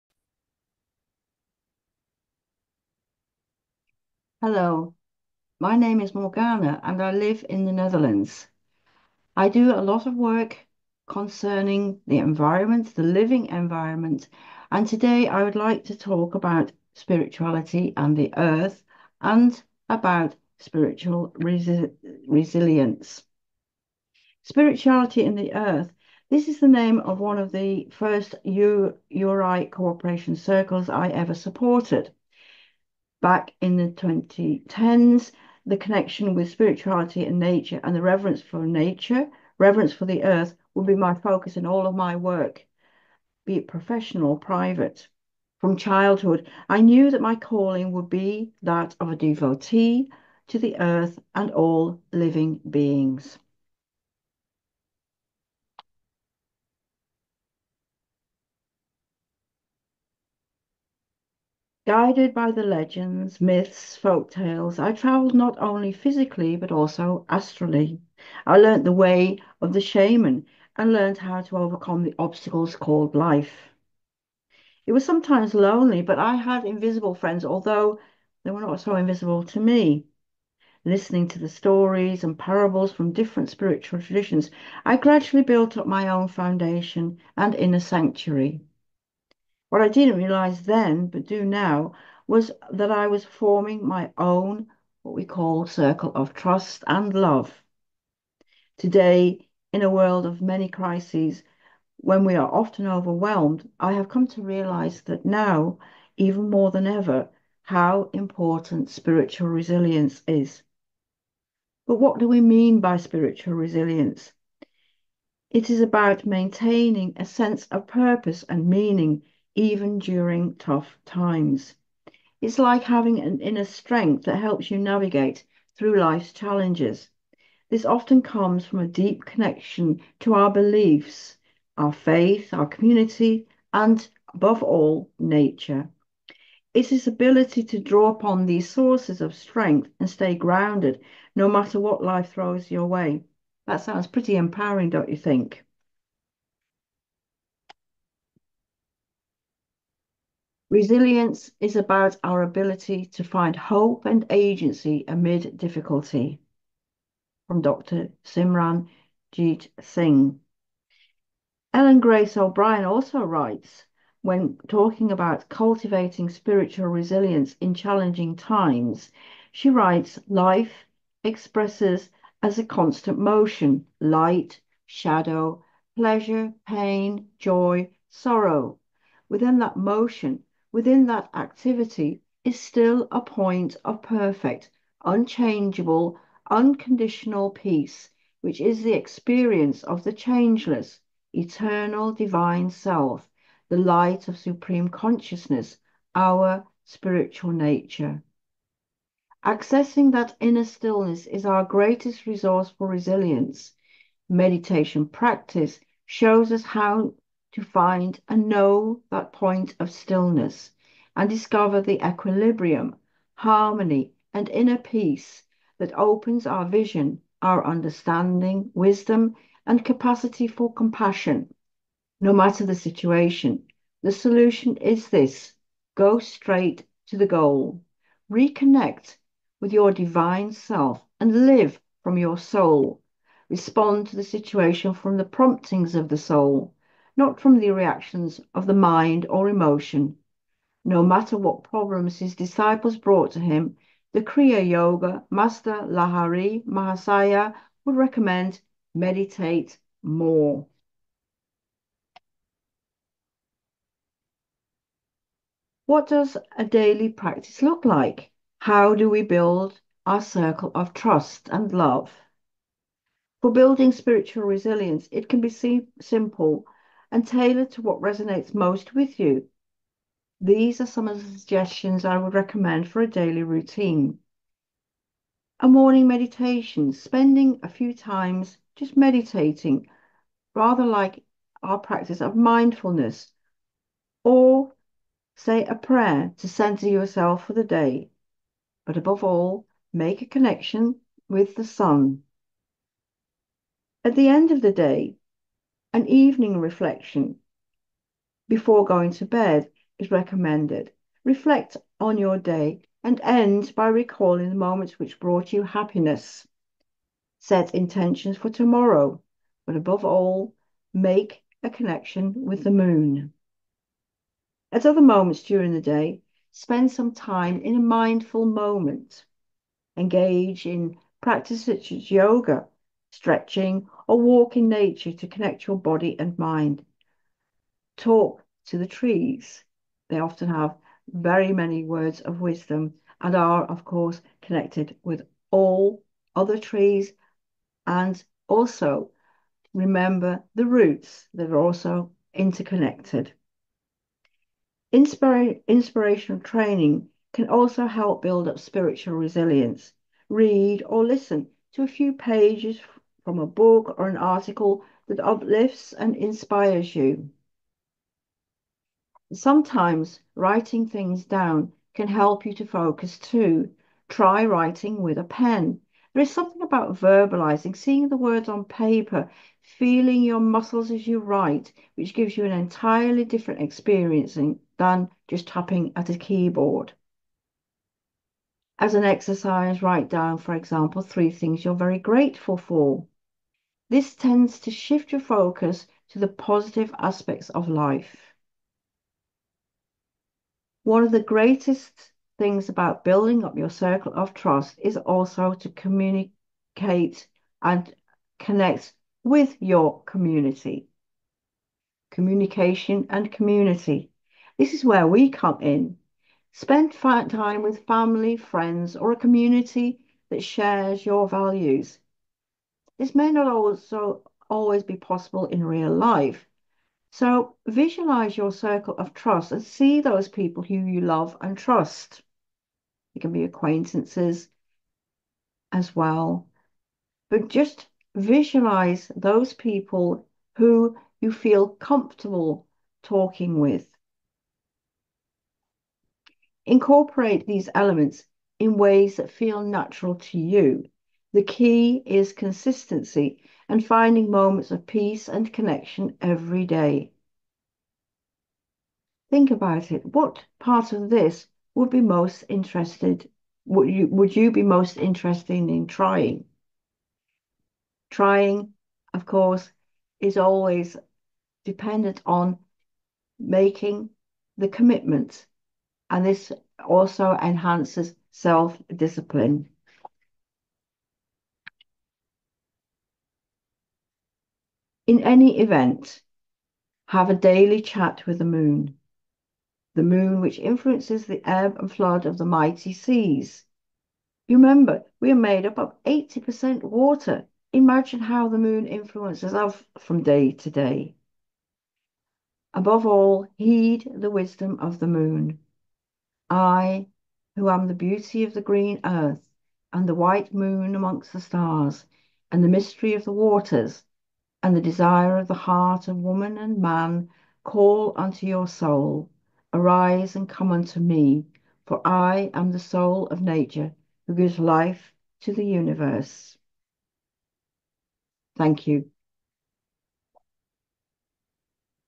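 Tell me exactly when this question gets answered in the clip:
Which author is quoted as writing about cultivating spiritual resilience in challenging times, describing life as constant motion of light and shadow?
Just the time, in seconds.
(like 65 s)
161 s.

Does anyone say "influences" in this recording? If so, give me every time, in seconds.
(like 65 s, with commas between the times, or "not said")
480 s, 488 s.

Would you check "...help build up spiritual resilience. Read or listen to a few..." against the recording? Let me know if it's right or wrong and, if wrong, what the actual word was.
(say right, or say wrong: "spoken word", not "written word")
right.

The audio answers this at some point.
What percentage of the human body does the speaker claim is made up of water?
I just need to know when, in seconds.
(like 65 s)
486 s.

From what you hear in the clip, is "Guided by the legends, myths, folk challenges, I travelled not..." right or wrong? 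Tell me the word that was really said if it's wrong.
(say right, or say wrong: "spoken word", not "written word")
wrong: "tales", not "challenges".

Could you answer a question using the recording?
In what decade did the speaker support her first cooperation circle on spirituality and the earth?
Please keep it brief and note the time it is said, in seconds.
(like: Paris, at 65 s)
2010s, at 33 s.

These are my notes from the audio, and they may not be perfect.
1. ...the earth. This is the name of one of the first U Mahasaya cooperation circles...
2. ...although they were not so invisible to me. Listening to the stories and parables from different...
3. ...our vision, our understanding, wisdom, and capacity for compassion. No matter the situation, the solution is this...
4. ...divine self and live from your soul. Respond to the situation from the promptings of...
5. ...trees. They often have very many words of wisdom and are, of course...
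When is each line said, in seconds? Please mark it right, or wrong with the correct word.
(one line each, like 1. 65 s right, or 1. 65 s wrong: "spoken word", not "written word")
1. 25 s wrong: "URI", not "Mahasaya"
2. 77 s right
3. 216 s right
4. 229 s right
5. 328 s right.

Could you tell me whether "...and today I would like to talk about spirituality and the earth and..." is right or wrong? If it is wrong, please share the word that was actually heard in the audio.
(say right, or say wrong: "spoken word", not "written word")
right.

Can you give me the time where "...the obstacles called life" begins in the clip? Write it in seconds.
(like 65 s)
72 s.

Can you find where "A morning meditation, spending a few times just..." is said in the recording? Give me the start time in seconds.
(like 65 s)
275 s.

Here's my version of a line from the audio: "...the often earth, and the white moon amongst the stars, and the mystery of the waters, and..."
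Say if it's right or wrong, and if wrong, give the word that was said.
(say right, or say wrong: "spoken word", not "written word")
wrong: "green", not "often".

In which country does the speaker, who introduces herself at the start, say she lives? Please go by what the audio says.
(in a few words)
the Netherlands.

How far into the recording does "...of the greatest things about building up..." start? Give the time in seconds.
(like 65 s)
391 s.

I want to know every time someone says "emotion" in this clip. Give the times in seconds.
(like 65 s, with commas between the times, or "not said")
239 s.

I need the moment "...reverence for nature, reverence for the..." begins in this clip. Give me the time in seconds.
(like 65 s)
38 s.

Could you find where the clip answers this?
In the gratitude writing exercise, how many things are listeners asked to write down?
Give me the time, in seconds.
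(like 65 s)
381 s.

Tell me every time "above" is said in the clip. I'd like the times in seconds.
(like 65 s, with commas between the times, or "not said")
134 s, 288 s, 309 s, 492 s.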